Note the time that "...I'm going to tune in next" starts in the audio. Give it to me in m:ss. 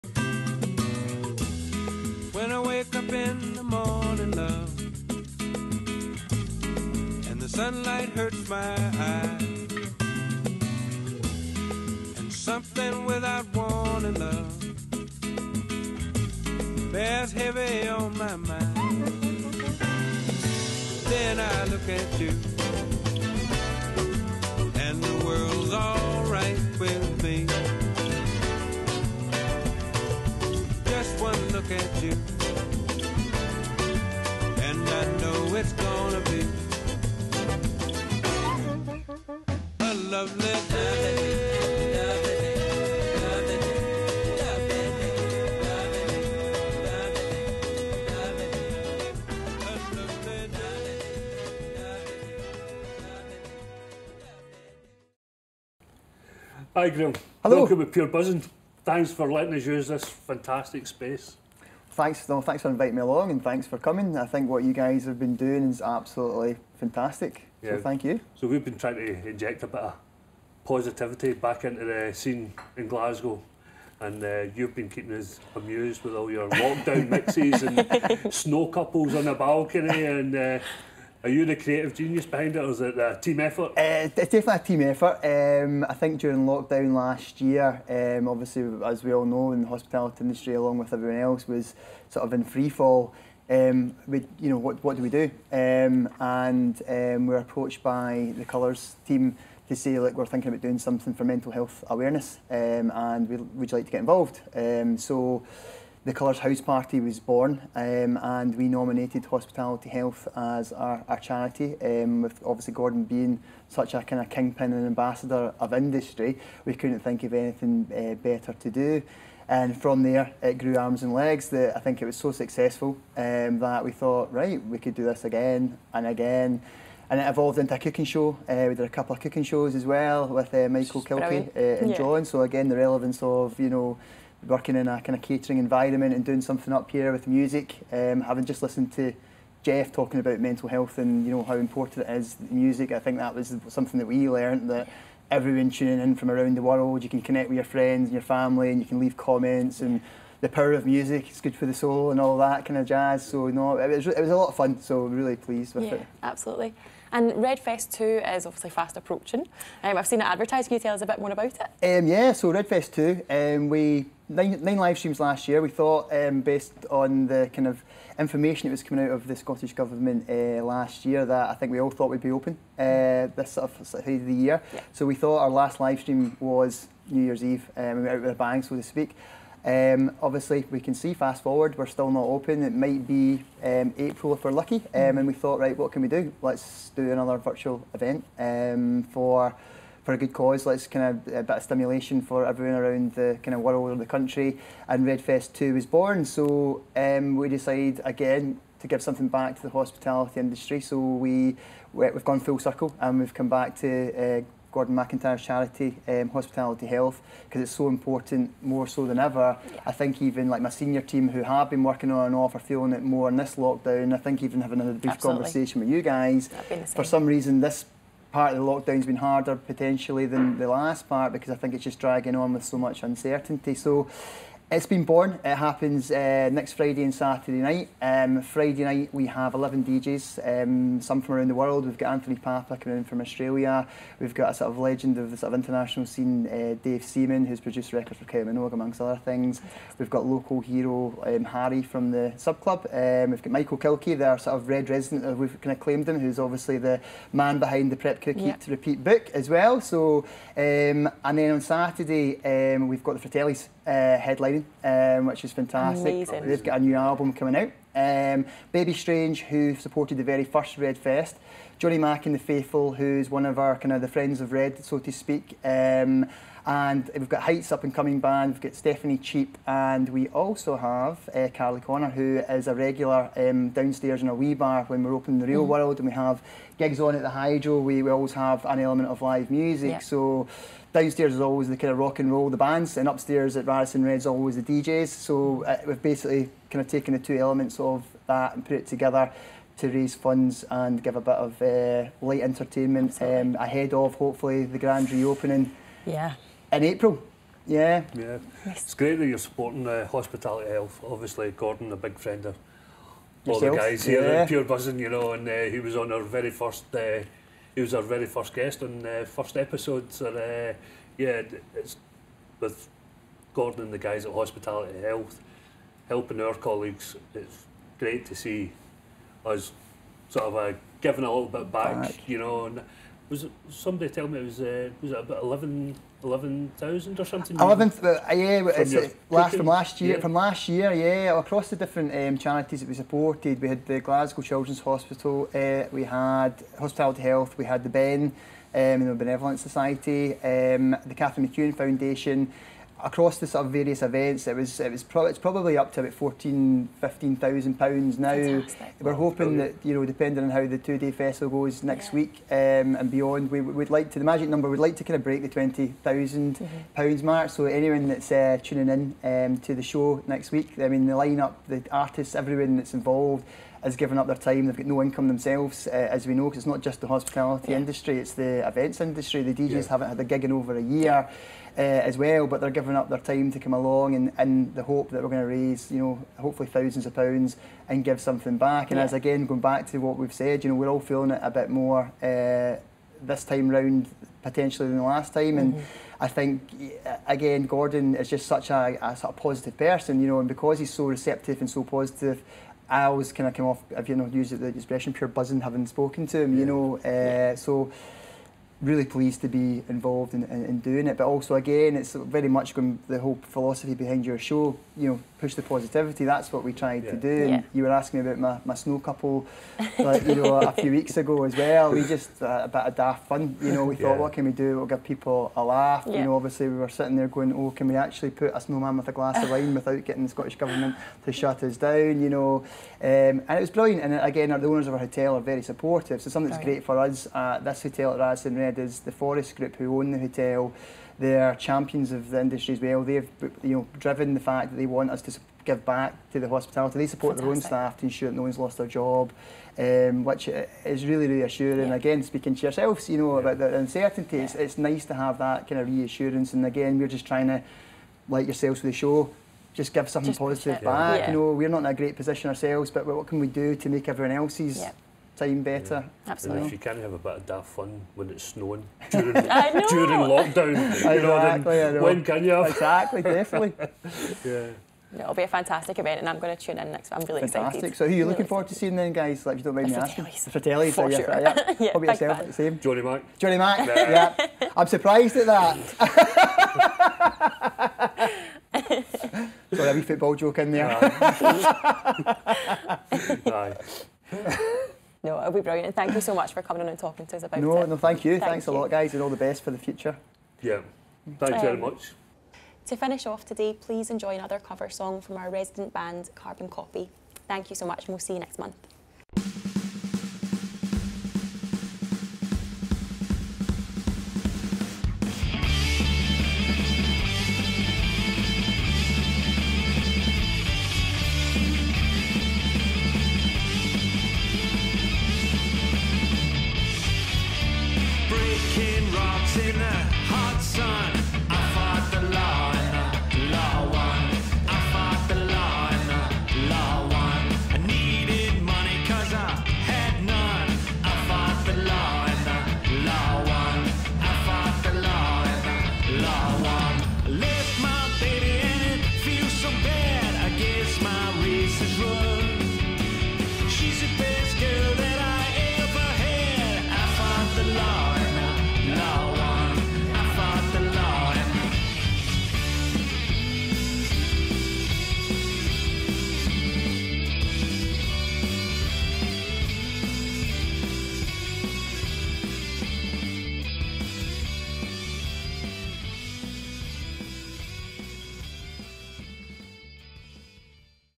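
7:46.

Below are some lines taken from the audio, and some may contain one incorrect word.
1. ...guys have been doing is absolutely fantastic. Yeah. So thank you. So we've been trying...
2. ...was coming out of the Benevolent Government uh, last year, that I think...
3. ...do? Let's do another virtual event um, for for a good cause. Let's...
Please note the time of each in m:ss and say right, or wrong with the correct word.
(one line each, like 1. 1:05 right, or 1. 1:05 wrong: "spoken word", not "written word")
1. 1:04 right
2. 2:48 wrong: "Scottish", not "Benevolent"
3. 3:06 right.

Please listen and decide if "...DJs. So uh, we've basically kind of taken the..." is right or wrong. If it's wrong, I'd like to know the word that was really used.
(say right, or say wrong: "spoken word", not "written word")
right.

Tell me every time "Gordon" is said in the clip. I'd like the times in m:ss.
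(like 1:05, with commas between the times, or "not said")
1:52, 3:24, 5:01, 5:13, 6:27.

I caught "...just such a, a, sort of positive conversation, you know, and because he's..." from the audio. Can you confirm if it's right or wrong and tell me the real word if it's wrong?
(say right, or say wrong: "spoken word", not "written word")
wrong: "person", not "conversation".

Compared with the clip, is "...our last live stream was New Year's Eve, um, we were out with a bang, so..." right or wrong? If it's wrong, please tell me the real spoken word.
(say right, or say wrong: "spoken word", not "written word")
right.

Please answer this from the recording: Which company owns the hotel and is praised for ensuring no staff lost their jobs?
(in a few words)
Forest Group.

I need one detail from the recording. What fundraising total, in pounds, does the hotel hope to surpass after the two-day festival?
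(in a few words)
£20,000.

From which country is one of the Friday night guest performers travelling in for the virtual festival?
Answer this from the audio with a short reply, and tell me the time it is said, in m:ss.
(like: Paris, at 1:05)
Australia, at 3:53.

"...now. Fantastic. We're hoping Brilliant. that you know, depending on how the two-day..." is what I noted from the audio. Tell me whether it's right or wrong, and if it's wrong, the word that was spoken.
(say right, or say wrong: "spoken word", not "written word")
right.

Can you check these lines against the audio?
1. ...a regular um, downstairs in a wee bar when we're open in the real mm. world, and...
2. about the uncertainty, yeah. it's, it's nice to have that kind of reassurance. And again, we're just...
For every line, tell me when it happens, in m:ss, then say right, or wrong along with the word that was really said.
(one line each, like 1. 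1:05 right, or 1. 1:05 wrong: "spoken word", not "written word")
1. 4:32 right
2. 7:23 right.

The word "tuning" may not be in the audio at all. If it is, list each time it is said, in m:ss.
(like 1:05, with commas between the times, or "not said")
2:25, 5:58.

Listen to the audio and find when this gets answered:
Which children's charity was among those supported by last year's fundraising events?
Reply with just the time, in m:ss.
5:34.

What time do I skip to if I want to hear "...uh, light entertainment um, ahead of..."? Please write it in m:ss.
4:51.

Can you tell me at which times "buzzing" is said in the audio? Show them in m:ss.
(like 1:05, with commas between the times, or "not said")
0:58, 5:04, 6:35.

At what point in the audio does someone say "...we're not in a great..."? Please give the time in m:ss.
7:31.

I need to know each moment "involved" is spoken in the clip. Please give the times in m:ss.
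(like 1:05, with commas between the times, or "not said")
1:43, 6:02, 6:39.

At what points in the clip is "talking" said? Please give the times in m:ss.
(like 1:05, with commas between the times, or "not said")
2:19, 8:06.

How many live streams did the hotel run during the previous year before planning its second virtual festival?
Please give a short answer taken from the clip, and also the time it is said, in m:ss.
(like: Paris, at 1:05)
9, at 2:44.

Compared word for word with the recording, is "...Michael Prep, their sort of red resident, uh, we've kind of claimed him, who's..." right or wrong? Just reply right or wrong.
wrong.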